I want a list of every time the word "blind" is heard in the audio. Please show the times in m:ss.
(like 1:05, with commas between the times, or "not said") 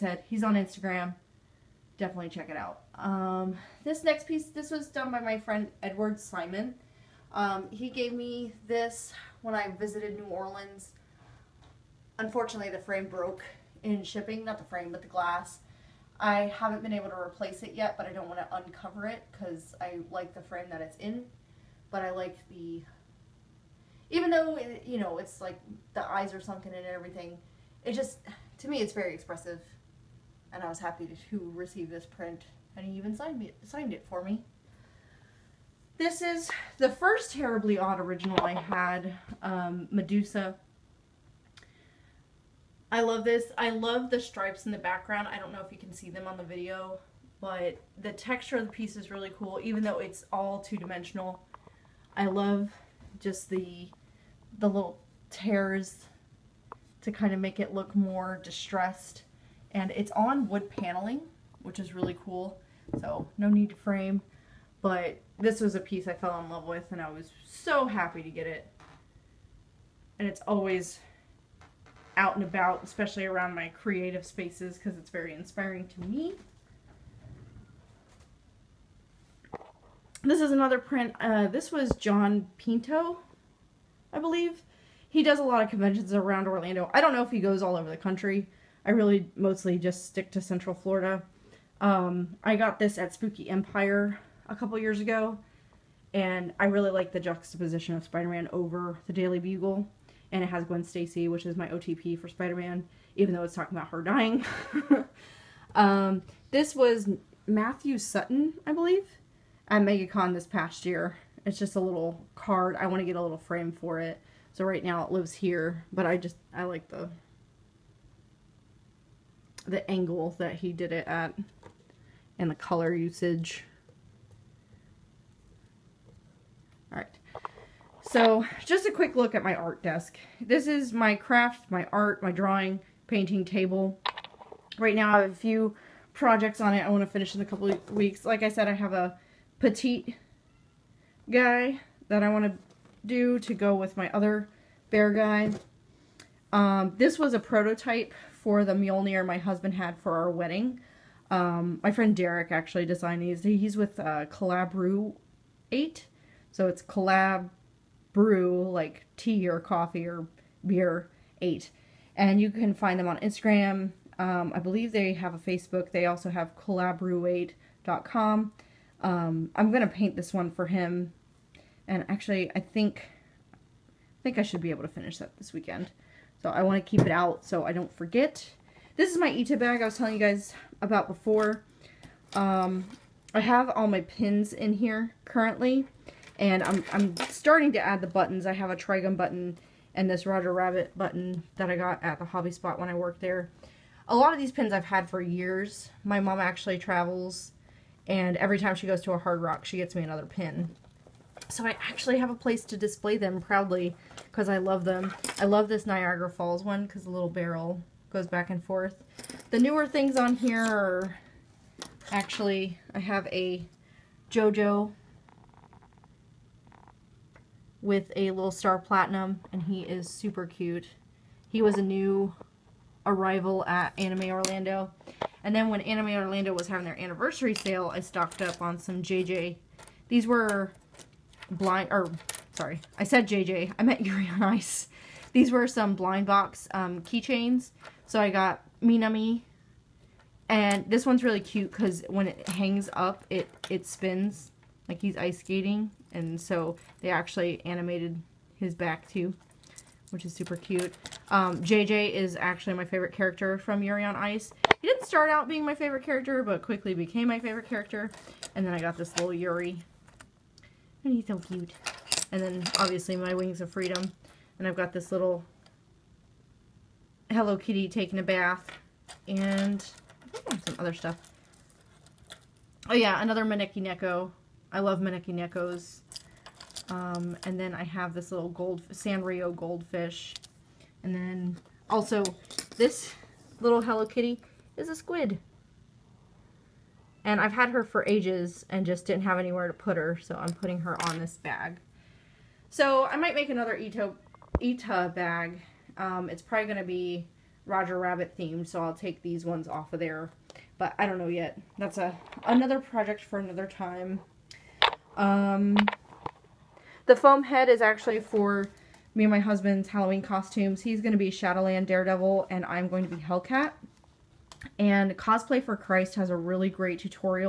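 3:51, 3:55.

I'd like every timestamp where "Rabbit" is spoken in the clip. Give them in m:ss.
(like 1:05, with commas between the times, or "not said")
3:10, 4:57.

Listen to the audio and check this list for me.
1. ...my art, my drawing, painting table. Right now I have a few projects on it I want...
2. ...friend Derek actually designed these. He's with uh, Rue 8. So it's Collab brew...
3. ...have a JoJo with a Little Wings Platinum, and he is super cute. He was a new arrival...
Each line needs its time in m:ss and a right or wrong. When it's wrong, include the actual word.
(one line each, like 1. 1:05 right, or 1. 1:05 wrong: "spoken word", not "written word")
1. 2:11 right
2. 2:31 right
3. 3:32 wrong: "Star", not "Wings".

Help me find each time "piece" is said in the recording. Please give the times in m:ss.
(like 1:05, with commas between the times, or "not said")
0:04, 0:48, 1:05.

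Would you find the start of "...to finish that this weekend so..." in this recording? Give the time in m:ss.
2:54.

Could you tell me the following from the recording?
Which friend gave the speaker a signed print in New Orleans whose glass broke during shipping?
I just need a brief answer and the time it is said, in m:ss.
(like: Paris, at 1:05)
Edward Simon, at 0:05.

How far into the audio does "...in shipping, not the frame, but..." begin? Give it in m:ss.
0:13.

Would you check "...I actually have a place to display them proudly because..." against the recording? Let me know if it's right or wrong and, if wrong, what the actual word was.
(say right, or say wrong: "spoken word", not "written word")
right.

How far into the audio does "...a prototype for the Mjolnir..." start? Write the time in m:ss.
2:27.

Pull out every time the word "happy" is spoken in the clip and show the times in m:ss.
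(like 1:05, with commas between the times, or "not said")
0:30, 1:07.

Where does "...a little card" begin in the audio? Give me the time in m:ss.
1:51.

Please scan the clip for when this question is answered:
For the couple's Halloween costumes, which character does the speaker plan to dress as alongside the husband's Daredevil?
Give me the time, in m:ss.
5:13.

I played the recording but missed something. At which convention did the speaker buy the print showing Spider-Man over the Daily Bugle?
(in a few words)
Spooky Empire.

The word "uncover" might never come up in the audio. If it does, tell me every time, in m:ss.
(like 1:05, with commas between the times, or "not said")
0:18.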